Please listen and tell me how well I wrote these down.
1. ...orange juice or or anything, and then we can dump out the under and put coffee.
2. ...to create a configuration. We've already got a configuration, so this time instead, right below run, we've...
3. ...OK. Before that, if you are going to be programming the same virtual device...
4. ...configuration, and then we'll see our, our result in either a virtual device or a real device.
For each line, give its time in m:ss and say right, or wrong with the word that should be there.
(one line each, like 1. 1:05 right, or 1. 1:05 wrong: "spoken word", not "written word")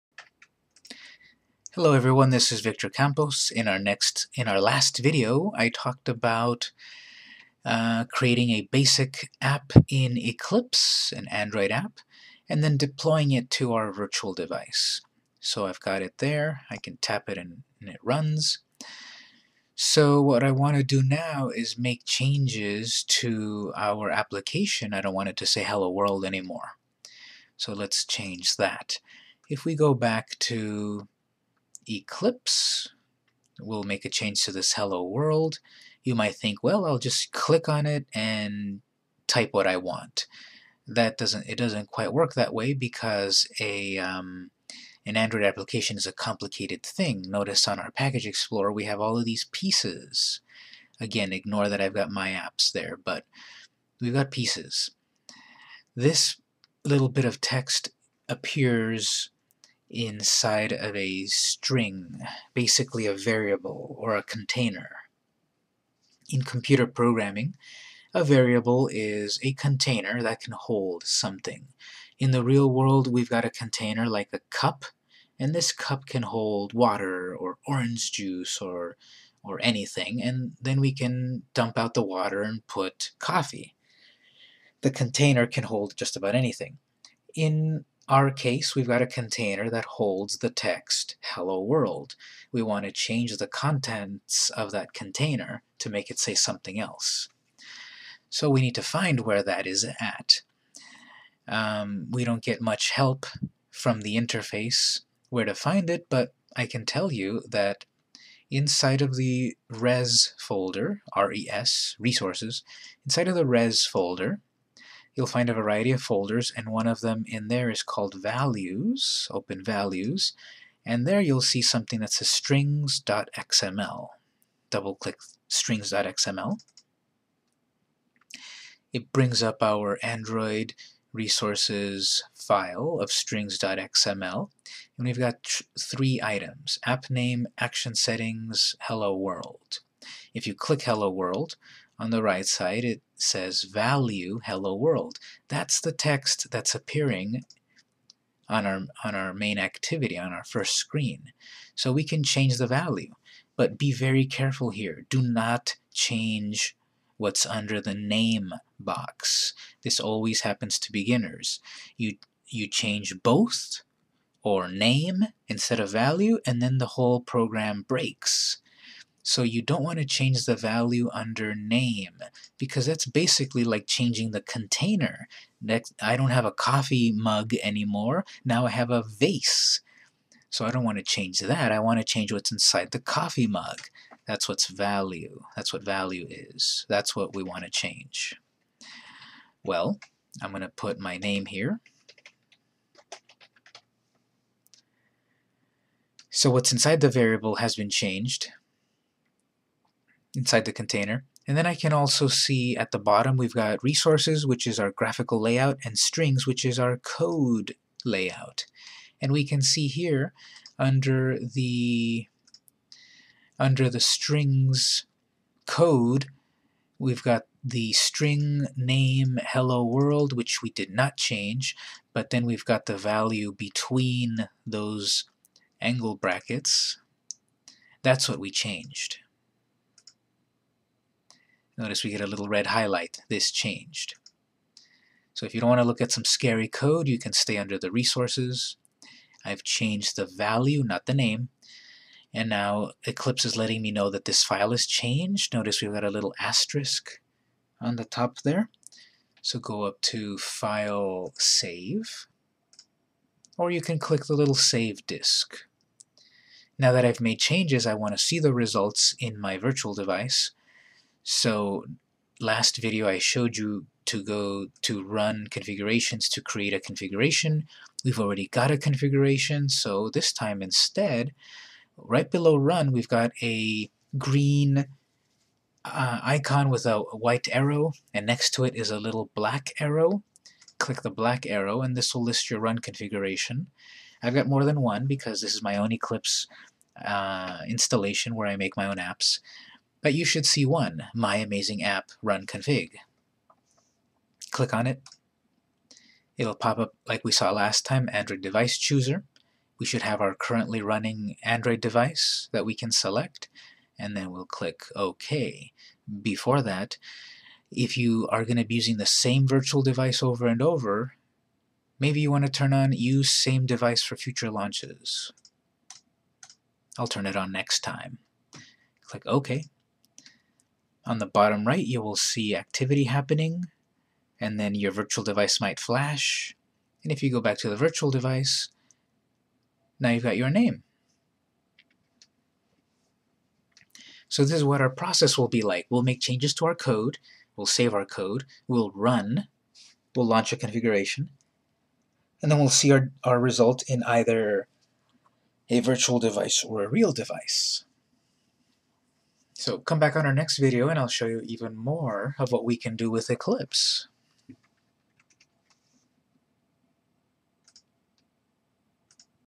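1. 1:17 wrong: "water", not "under"
2. 4:26 right
3. 5:04 wrong: "using", not "programming"
4. 5:40 right.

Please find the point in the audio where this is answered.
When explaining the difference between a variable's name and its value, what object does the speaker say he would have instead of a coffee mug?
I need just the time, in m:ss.
2:58.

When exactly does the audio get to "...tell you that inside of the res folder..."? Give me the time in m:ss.
1:46.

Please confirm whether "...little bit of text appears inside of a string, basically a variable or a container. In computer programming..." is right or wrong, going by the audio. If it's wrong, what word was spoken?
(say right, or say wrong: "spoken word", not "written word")
right.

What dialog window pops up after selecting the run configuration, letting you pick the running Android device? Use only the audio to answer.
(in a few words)
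Android Device Chooser.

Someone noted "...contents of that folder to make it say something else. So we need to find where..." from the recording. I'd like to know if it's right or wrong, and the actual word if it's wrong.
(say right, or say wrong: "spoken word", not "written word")
wrong: "container", not "folder".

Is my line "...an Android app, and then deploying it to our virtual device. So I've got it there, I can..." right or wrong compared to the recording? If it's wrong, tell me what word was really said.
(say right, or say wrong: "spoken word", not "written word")
right.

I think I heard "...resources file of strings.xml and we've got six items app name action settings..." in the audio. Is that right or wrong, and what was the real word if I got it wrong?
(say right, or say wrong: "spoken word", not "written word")
wrong: "three", not "six".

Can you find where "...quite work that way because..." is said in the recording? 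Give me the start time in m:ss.
0:41.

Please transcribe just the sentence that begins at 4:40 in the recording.
Click the black arrow, and this will list your run configuration.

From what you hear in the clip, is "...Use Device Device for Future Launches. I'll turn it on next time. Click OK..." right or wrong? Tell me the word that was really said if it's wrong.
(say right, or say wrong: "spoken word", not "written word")
wrong: "Same", not "Device".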